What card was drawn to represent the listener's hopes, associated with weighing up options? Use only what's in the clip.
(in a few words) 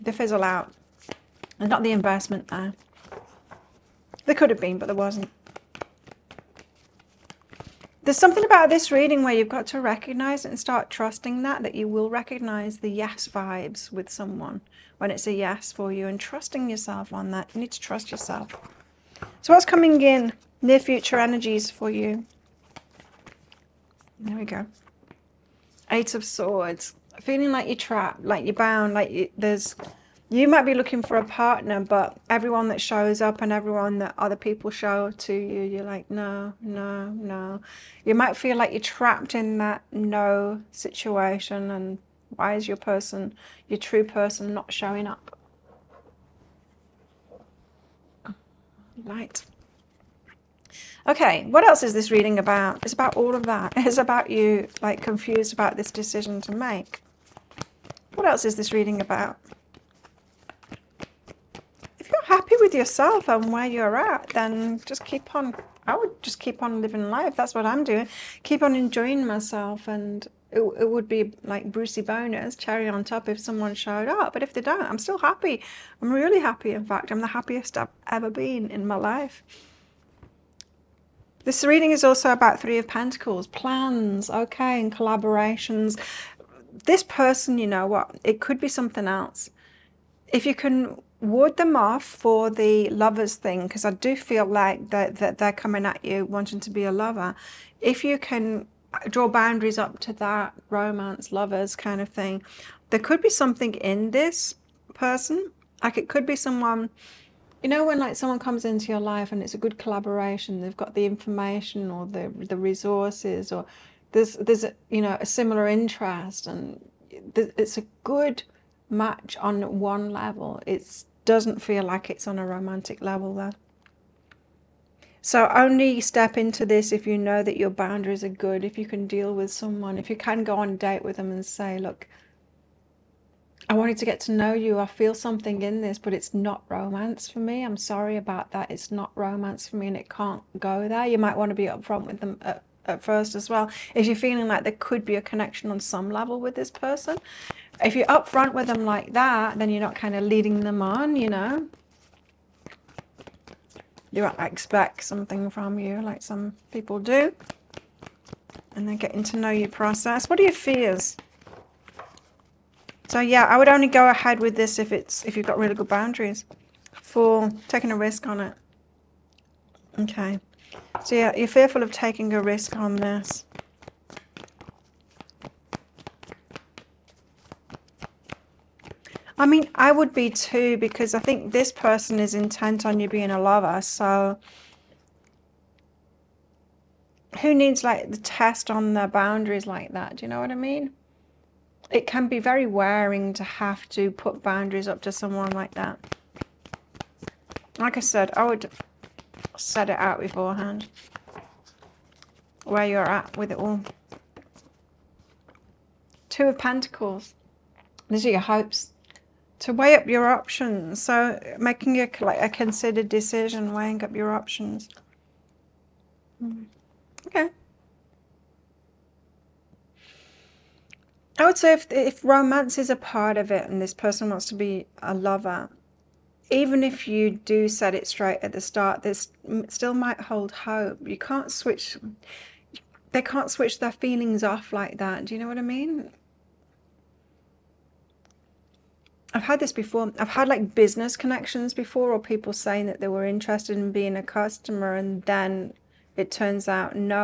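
Two of Pentacles.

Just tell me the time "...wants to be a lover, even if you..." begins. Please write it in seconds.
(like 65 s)
224 s.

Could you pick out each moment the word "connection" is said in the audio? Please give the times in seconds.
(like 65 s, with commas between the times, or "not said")
145 s, 241 s.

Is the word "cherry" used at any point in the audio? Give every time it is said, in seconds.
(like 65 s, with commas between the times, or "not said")
72 s.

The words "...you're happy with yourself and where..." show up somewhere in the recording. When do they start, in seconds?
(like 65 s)
62 s.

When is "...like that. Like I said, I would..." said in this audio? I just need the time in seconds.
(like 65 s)
195 s.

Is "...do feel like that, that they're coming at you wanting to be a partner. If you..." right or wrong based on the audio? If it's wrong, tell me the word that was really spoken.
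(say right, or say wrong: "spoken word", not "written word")
wrong: "lover", not "partner".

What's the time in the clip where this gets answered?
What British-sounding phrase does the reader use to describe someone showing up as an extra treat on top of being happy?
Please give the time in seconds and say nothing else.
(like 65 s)
71 s.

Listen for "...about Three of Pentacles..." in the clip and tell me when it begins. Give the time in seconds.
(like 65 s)
82 s.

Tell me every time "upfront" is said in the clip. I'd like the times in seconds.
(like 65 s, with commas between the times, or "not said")
141 s, 148 s.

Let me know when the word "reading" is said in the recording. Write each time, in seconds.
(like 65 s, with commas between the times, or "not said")
8 s, 52 s, 58 s, 81 s.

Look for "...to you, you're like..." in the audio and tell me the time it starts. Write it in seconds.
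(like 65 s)
35 s.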